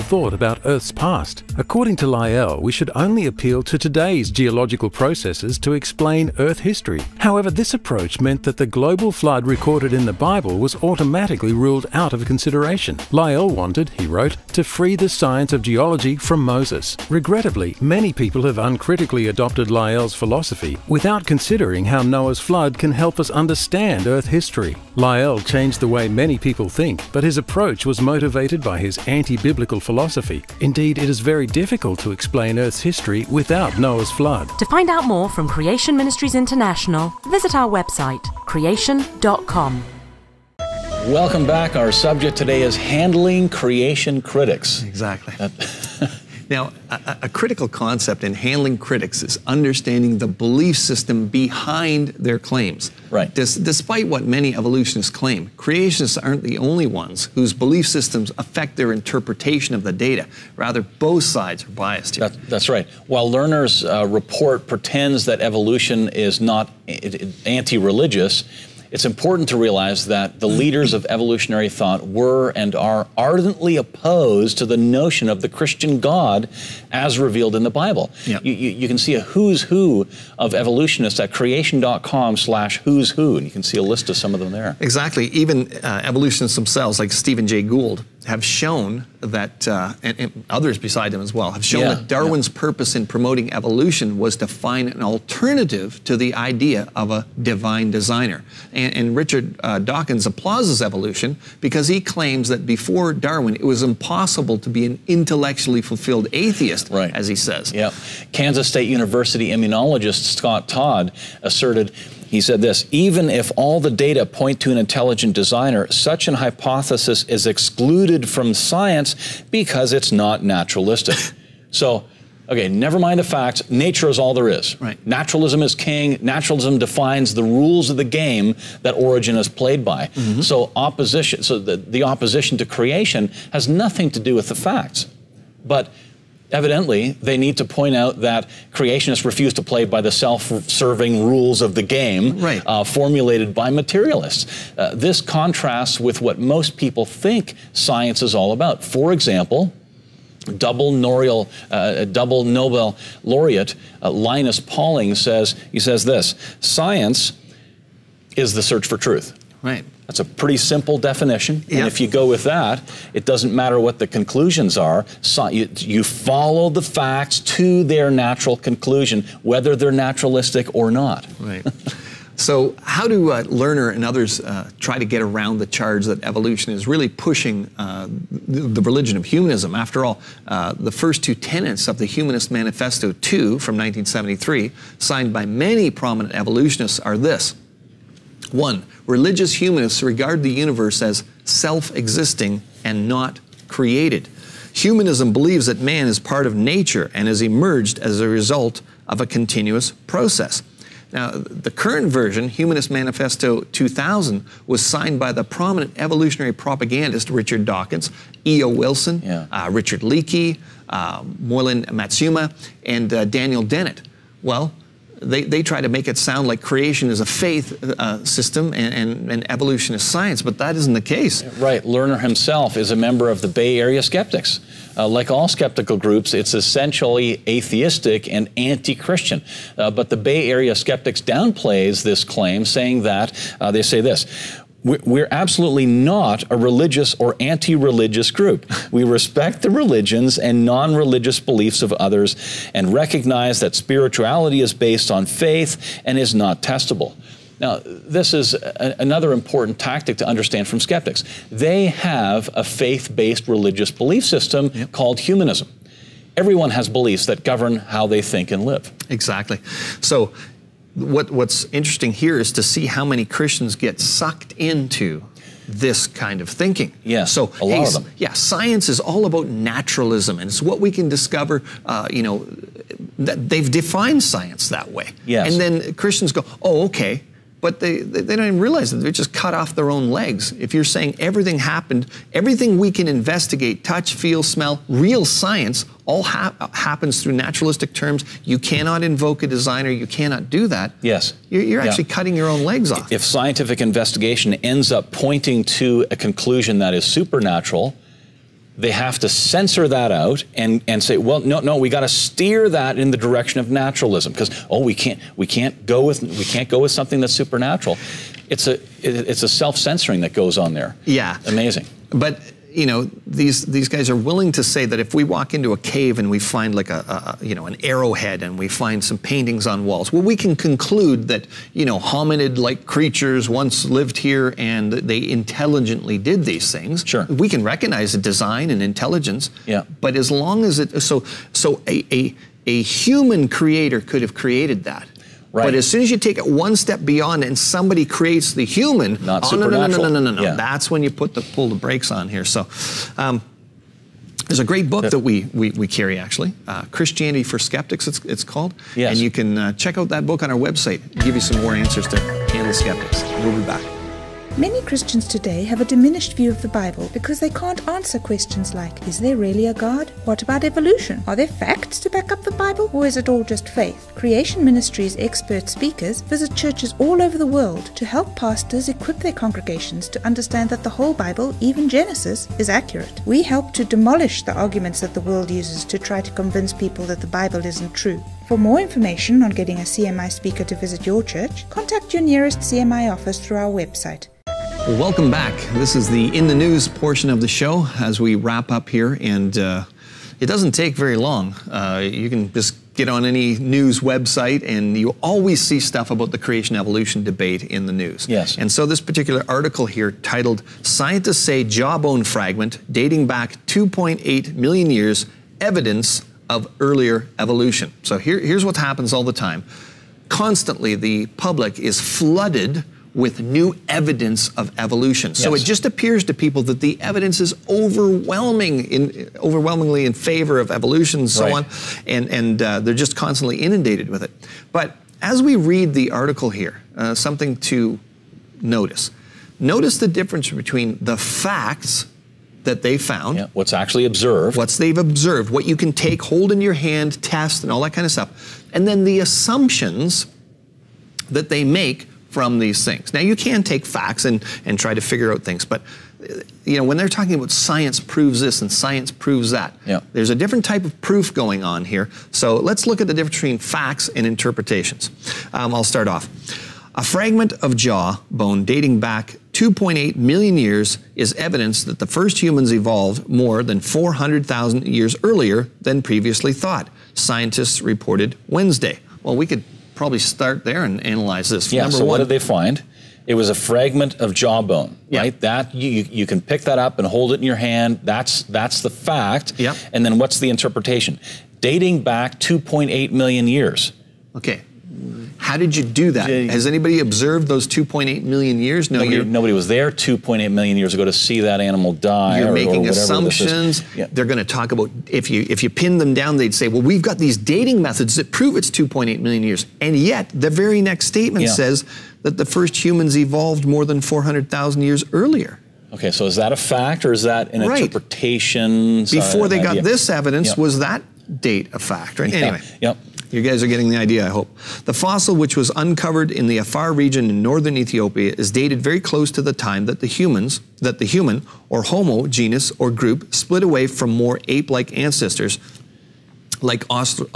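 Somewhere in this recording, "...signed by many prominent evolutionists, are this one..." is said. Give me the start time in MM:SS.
03:04.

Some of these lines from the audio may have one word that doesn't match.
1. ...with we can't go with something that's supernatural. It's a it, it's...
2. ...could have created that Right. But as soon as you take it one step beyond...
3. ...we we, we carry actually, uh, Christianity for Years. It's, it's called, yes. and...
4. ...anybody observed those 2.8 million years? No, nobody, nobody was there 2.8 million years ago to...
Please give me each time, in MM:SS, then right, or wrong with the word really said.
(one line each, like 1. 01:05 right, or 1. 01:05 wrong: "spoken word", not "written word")
1. 05:06 right
2. 05:34 right
3. 05:45 wrong: "Skeptics", not "Years"
4. 08:06 right.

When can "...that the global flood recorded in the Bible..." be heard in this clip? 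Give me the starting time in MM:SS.
00:08.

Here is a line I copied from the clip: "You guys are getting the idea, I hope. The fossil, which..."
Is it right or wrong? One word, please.
right.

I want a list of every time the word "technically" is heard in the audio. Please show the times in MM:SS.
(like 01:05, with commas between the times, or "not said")
not said.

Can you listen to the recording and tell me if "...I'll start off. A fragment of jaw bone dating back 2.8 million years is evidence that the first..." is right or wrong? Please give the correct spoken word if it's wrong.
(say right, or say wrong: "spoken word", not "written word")
right.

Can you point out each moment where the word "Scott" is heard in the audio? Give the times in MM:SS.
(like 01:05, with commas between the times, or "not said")
01:50.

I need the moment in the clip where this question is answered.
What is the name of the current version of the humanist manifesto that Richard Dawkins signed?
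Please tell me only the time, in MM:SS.
03:22.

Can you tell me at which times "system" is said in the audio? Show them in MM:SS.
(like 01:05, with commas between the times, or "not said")
00:50, 00:57, 03:38, 04:14.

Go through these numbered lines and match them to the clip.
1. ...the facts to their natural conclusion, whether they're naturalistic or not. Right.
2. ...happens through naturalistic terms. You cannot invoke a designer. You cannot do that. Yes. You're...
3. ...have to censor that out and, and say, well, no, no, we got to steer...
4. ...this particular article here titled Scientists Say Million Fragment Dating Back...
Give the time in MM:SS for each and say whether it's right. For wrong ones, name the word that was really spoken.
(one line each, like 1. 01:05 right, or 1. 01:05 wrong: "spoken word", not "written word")
1. 02:46 right
2. 04:46 right
3. 04:58 right
4. 06:38 wrong: "Jawbone", not "Million".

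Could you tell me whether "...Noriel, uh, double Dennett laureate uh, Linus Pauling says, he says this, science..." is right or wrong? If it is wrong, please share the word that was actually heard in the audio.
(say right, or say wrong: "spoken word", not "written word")
wrong: "Nobel", not "Dennett".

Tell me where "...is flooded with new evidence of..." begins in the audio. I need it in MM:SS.
06:51.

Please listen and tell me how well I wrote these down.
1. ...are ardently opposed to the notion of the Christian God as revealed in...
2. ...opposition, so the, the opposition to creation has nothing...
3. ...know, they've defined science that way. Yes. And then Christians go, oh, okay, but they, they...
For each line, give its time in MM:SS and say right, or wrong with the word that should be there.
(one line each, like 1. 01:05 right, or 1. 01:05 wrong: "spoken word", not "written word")
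1. 01:12 right
2. 02:10 right
3. 04:32 right.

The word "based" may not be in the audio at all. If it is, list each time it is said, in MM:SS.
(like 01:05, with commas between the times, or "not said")
04:04, 04:13.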